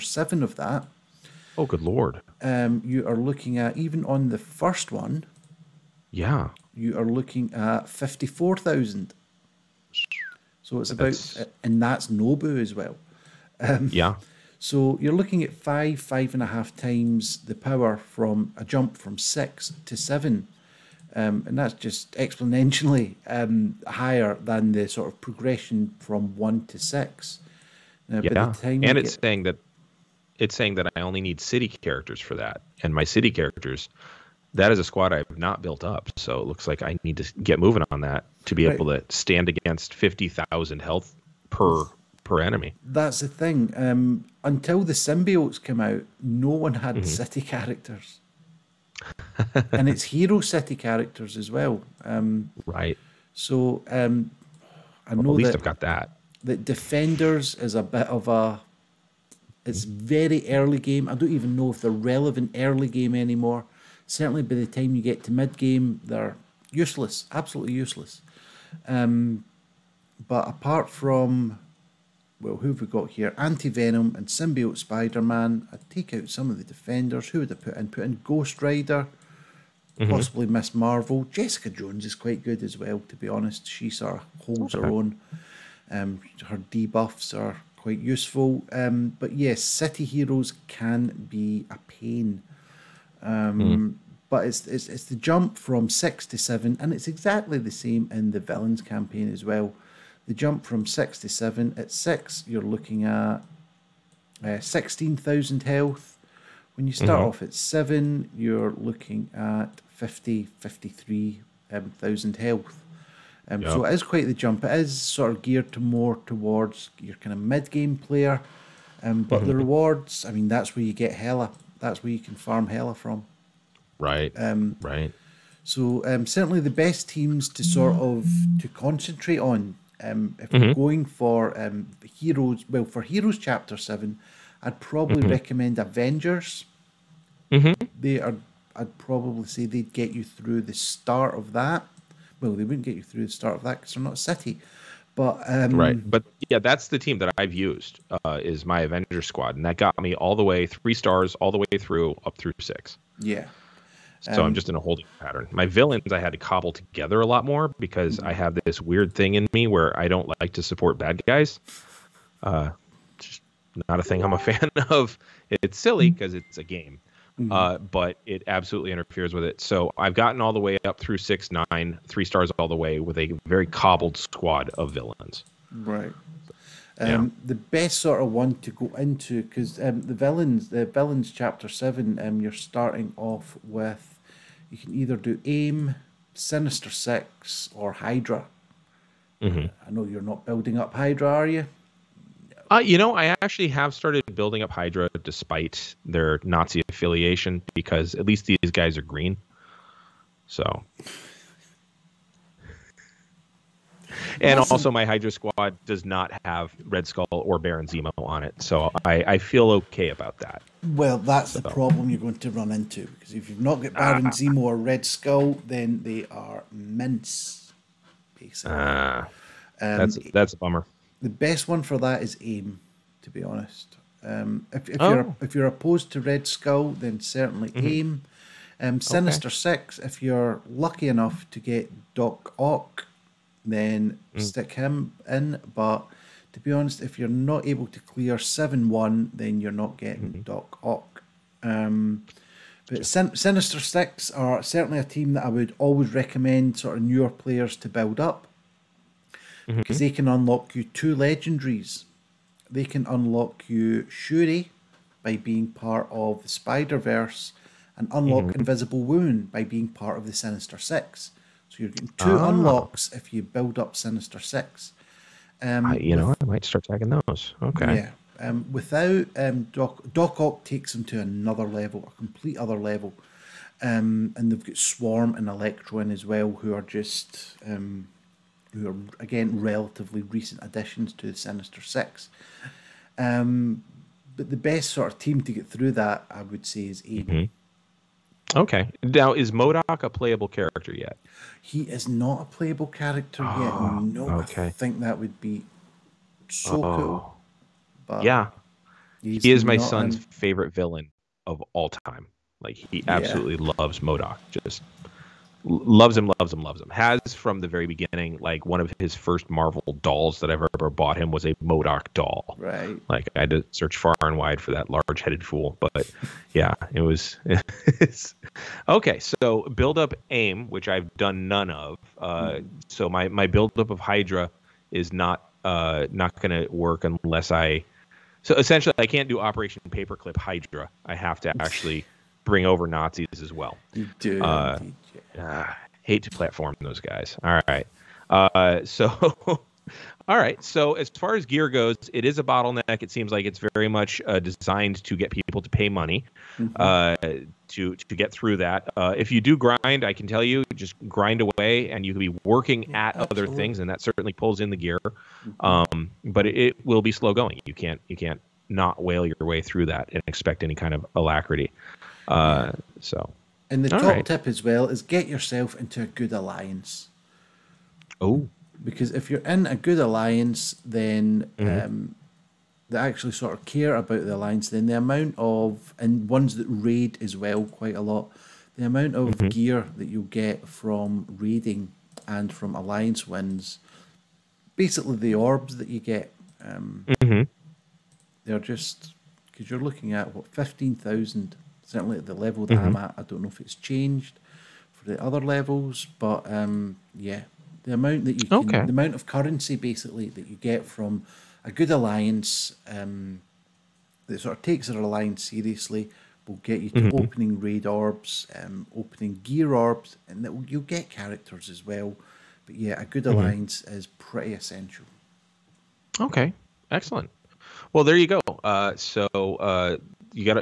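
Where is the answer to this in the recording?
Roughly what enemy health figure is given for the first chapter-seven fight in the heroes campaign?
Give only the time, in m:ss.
0:07.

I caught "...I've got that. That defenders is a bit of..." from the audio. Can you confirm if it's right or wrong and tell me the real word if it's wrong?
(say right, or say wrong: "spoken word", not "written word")
right.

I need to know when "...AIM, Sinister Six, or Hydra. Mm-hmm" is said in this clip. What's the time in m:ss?
3:05.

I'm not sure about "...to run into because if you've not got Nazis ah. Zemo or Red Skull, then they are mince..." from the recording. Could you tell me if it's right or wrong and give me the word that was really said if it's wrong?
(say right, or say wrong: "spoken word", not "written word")
wrong: "Baron", not "Nazis".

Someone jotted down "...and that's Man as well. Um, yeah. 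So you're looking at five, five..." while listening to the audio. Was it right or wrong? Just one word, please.
wrong.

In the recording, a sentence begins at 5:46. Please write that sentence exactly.
Uh, to to get through that.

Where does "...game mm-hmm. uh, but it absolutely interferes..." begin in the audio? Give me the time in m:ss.
2:46.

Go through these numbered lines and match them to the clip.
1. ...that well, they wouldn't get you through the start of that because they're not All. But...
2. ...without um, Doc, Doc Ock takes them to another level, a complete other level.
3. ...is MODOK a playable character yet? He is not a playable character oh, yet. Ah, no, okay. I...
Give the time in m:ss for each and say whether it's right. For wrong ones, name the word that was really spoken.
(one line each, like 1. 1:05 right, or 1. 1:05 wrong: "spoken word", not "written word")
1. 2:21 wrong: "City", not "All"
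2. 4:28 right
3. 4:49 right.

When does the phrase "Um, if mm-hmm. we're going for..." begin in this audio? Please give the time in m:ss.
2:10.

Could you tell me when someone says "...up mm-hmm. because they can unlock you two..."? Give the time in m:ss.
4:08.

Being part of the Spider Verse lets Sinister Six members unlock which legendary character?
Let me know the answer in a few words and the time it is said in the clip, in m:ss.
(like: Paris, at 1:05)
Shuri, at 4:14.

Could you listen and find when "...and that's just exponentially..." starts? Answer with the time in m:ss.
0:21.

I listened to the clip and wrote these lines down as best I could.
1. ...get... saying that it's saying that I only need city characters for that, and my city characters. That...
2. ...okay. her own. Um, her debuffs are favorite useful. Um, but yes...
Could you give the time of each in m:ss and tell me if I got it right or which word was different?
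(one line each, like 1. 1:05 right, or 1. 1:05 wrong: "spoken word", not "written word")
1. 0:29 right
2. 1:24 wrong: "quite", not "favorite".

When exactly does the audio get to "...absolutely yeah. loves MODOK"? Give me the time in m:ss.
5:03.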